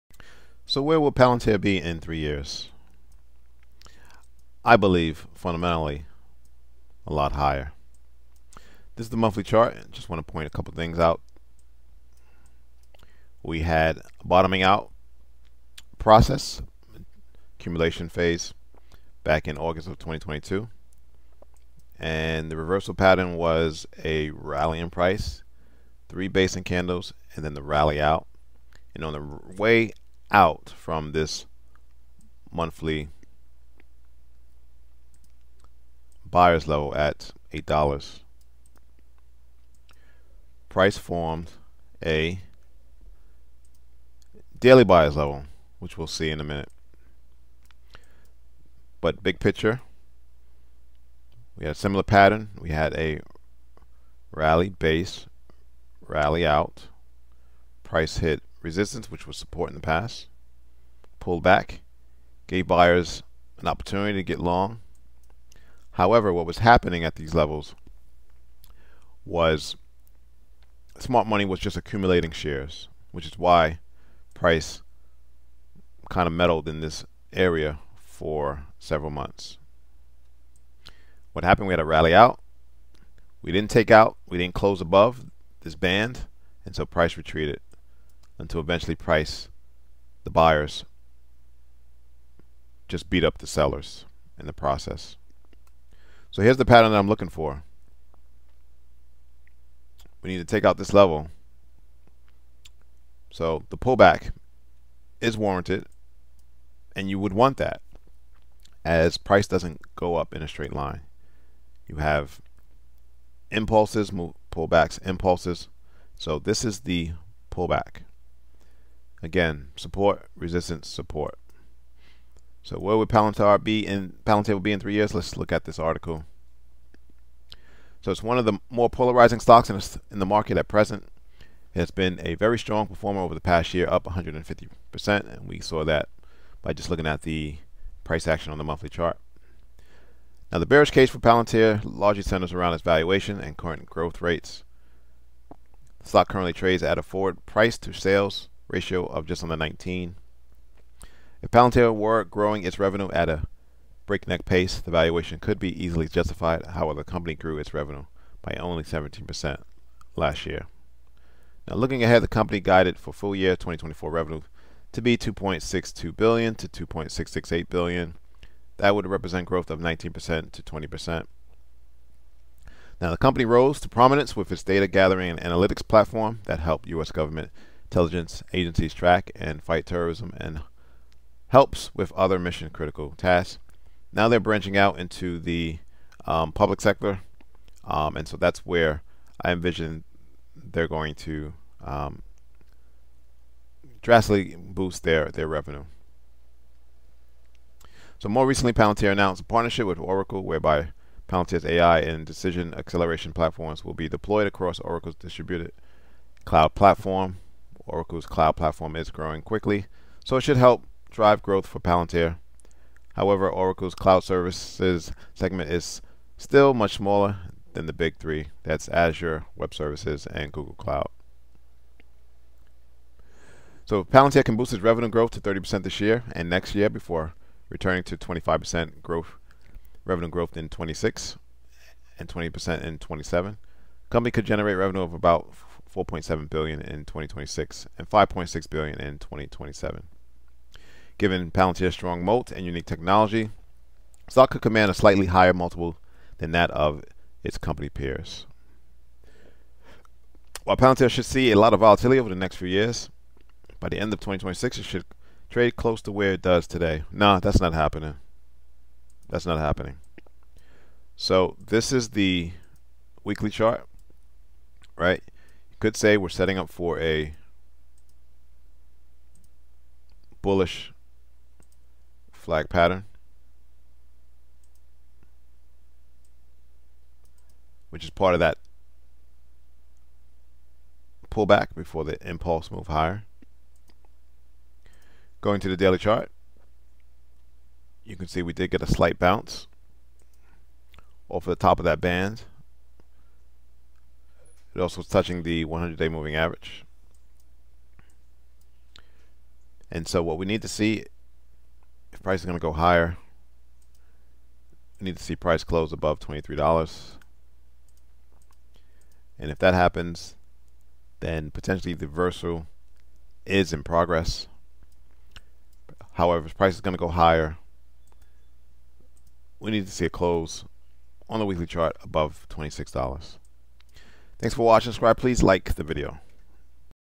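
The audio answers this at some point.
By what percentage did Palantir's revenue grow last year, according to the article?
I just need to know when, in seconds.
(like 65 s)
158 s.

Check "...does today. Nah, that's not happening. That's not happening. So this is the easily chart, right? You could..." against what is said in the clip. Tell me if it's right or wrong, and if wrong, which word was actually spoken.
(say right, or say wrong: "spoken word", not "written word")
wrong: "weekly", not "easily".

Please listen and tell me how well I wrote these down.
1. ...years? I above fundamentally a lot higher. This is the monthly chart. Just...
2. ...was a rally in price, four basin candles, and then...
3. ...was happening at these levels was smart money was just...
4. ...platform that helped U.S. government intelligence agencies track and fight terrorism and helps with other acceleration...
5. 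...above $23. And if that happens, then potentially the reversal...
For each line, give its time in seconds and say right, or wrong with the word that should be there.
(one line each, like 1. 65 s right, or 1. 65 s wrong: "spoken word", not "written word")
1. 2 s wrong: "believe", not "above"
2. 23 s wrong: "three", not "four"
3. 66 s right
4. 175 s wrong: "mission", not "acceleration"
5. 305 s right.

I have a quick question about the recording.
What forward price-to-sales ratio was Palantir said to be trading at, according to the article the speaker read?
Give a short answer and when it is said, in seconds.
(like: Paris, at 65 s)
just under 19, at 149 s.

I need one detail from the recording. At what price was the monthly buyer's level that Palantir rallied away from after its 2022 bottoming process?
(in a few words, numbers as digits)
$8.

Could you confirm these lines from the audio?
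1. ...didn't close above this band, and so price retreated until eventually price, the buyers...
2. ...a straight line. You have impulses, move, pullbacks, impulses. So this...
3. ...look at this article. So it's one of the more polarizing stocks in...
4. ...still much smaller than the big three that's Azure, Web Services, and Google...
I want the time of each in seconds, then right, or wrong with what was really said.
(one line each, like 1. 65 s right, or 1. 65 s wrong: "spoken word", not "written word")
1. 84 s right
2. 110 s right
3. 125 s right
4. 216 s right.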